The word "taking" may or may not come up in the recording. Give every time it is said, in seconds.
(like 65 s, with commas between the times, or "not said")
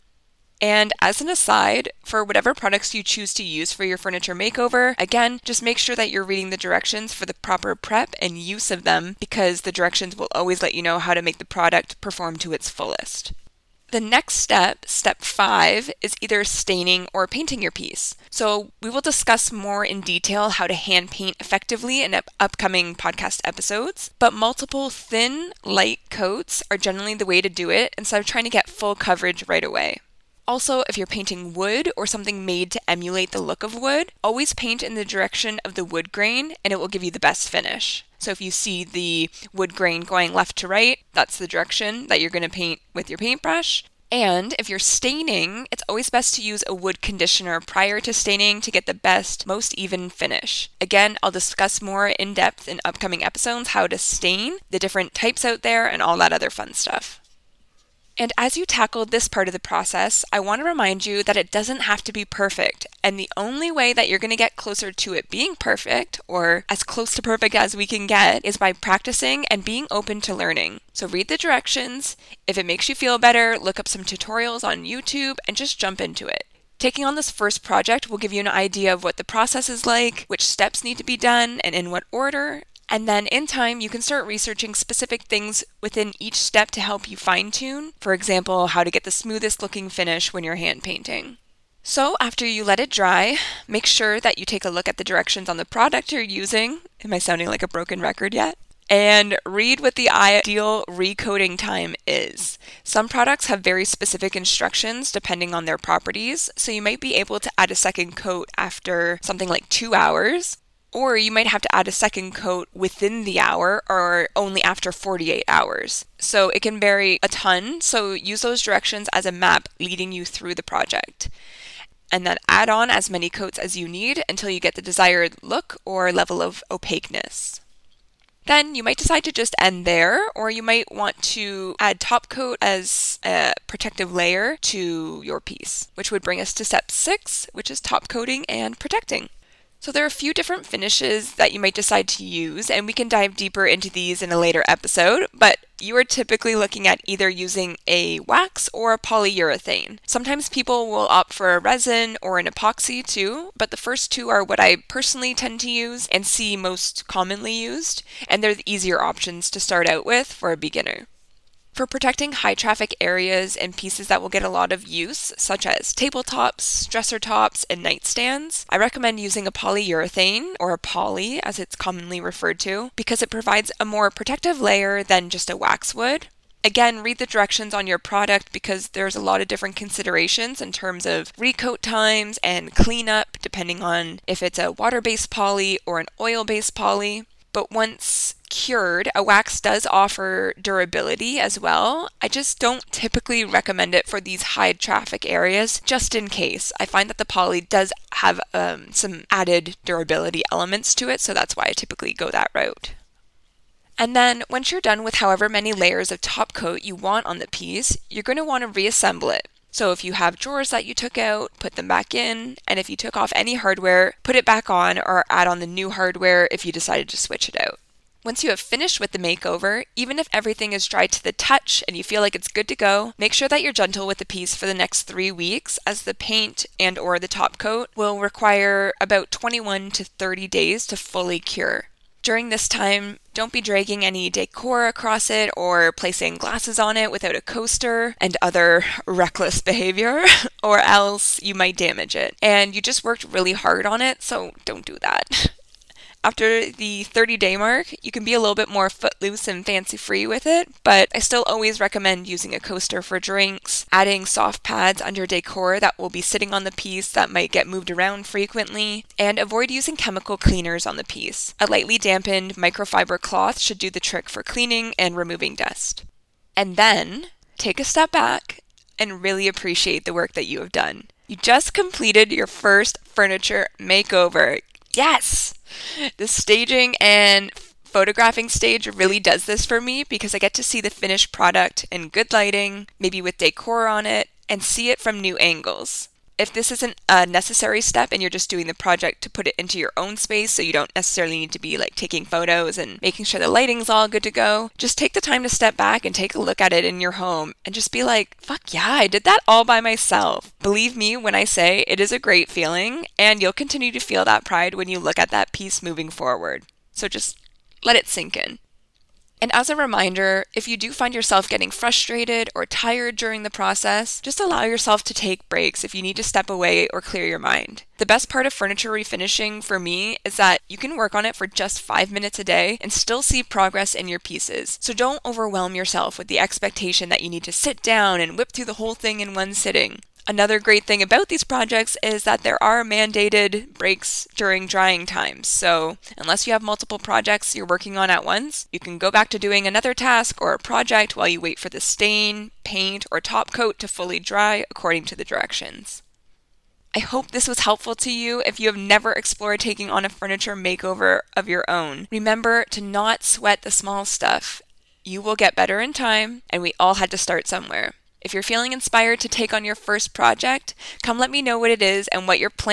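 76 s, 291 s, 349 s.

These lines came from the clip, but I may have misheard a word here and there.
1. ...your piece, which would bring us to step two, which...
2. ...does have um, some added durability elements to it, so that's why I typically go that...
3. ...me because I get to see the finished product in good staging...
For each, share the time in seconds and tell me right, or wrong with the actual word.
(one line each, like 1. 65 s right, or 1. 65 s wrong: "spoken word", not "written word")
1. 135 s wrong: "six", not "two"
2. 197 s right
3. 279 s wrong: "lighting", not "staging".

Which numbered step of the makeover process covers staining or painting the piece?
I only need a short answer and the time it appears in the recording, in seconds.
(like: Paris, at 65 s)
5, at 14 s.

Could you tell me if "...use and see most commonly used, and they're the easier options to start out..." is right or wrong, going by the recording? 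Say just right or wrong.
right.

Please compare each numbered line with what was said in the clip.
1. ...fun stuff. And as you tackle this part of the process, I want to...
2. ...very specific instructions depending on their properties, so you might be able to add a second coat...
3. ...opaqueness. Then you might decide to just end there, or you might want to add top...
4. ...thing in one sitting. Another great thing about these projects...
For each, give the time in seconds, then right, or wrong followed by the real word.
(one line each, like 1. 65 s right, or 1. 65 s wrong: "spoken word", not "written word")
1. 56 s right
2. 103 s right
3. 126 s right
4. 328 s right.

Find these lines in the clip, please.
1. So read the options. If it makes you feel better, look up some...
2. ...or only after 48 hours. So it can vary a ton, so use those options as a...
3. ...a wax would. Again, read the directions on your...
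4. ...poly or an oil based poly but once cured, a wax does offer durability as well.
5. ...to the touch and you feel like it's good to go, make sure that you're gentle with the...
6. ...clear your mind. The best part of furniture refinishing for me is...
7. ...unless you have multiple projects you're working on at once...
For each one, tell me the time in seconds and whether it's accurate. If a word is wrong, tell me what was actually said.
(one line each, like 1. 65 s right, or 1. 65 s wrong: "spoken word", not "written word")
1. 70 s wrong: "directions", not "options"
2. 113 s wrong: "directions", not "options"
3. 175 s right
4. 185 s right
5. 221 s right
6. 316 s right
7. 336 s right.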